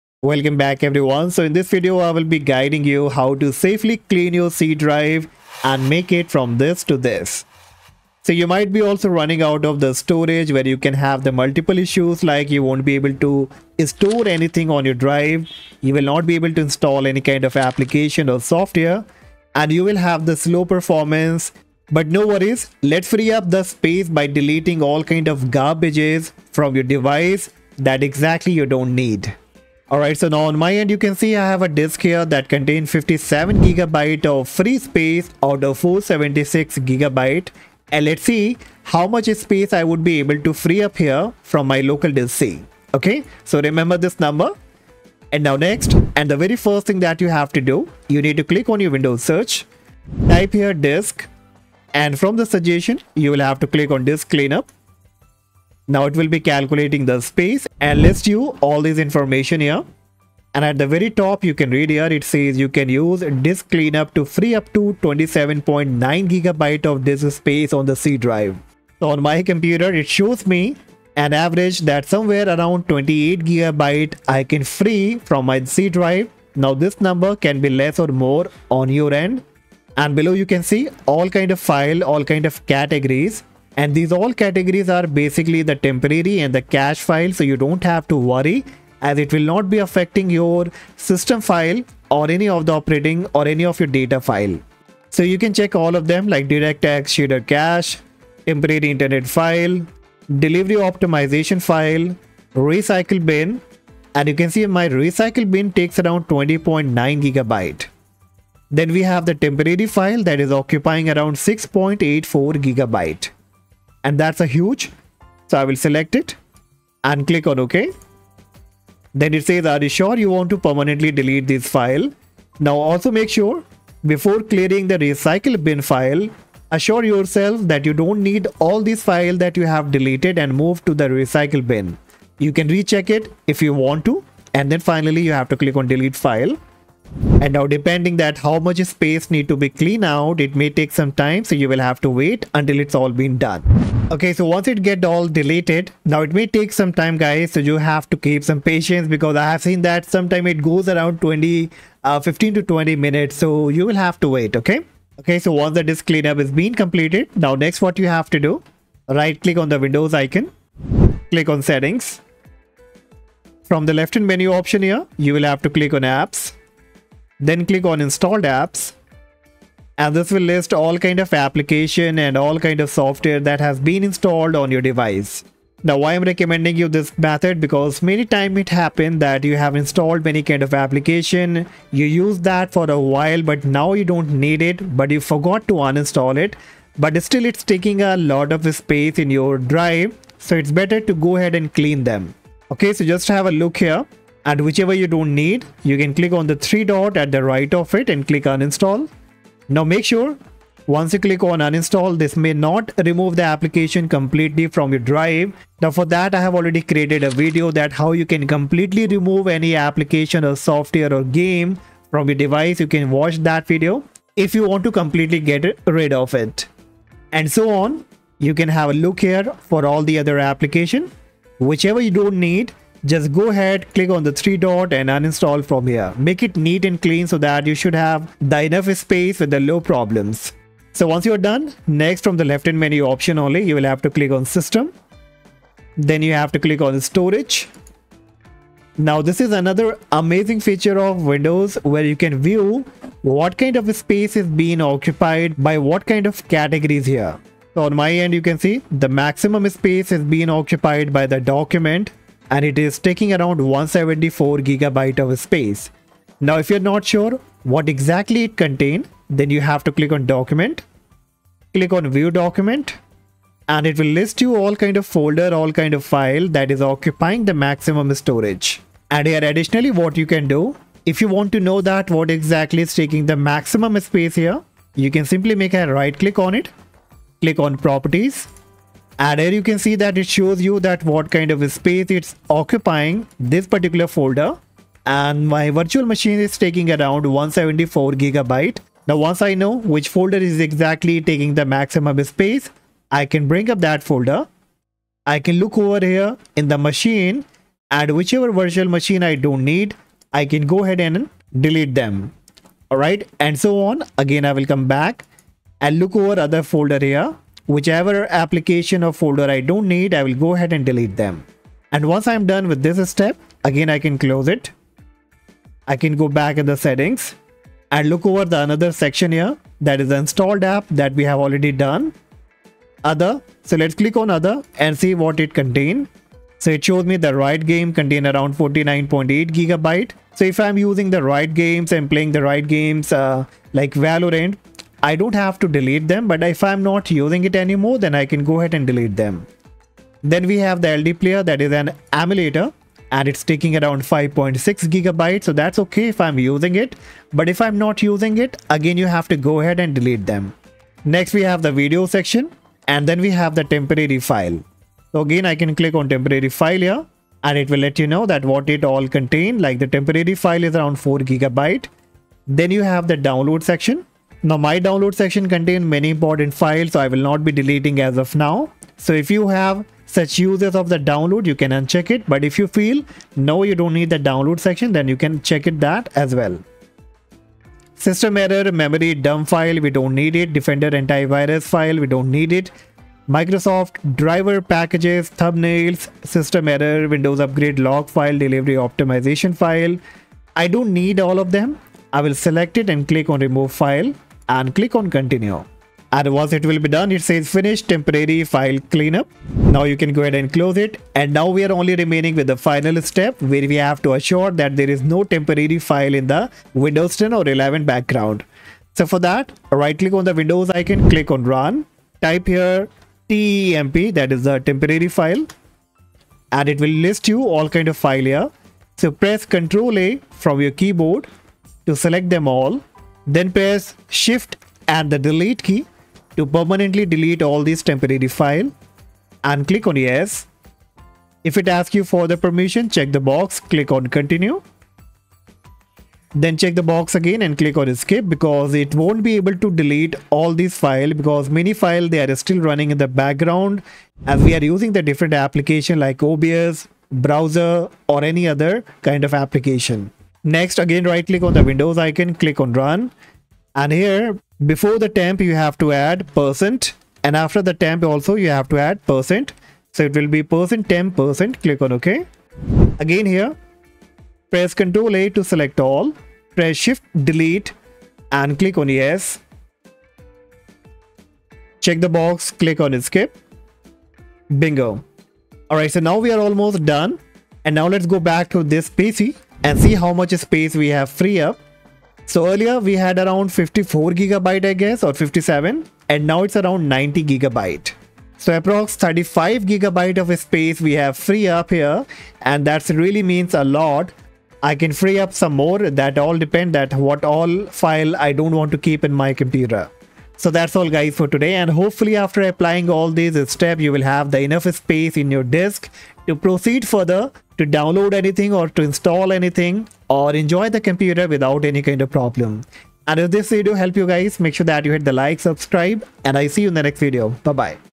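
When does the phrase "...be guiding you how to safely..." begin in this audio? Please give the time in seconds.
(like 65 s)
2 s.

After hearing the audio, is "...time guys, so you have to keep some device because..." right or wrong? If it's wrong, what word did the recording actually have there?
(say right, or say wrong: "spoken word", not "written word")
wrong: "patience", not "device".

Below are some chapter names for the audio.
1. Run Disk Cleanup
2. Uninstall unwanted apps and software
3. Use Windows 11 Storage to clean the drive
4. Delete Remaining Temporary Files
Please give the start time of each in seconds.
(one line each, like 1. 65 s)
1. 45 s
2. 155 s
3. 230 s
4. 405 s.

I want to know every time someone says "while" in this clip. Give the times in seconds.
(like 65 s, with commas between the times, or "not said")
182 s.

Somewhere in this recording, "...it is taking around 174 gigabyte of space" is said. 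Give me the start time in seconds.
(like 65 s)
252 s.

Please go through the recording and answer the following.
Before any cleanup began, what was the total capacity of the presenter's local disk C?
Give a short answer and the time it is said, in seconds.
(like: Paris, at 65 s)
476 gigabytes, at 35 s.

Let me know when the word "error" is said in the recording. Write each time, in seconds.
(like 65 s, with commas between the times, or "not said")
378 s, 386 s.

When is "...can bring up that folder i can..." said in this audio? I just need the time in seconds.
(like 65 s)
293 s.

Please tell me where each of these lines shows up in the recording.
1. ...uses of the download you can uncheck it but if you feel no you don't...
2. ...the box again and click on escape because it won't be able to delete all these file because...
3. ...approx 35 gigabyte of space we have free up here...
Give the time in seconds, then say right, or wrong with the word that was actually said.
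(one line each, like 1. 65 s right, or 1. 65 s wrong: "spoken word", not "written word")
1. 370 s right
2. 436 s right
3. 488 s right.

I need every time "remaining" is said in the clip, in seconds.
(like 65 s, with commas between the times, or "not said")
401 s.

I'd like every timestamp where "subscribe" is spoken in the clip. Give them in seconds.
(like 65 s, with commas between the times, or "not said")
515 s.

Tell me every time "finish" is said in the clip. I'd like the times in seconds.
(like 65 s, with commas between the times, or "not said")
397 s.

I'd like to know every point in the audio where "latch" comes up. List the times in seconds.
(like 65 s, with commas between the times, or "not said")
not said.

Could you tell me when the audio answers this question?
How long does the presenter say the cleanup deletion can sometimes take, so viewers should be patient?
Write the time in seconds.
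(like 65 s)
152 s.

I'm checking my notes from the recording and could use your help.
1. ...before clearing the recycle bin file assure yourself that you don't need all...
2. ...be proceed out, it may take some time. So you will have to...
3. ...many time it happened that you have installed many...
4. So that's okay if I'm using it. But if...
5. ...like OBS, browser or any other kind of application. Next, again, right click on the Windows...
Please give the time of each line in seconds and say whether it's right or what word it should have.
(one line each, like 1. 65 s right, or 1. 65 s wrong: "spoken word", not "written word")
1. 124 s right
2. 139 s wrong: "cleaned", not "proceed"
3. 178 s right
4. 345 s right
5. 445 s right.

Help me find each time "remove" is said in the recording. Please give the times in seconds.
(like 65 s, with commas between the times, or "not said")
203 s, 209 s, 393 s.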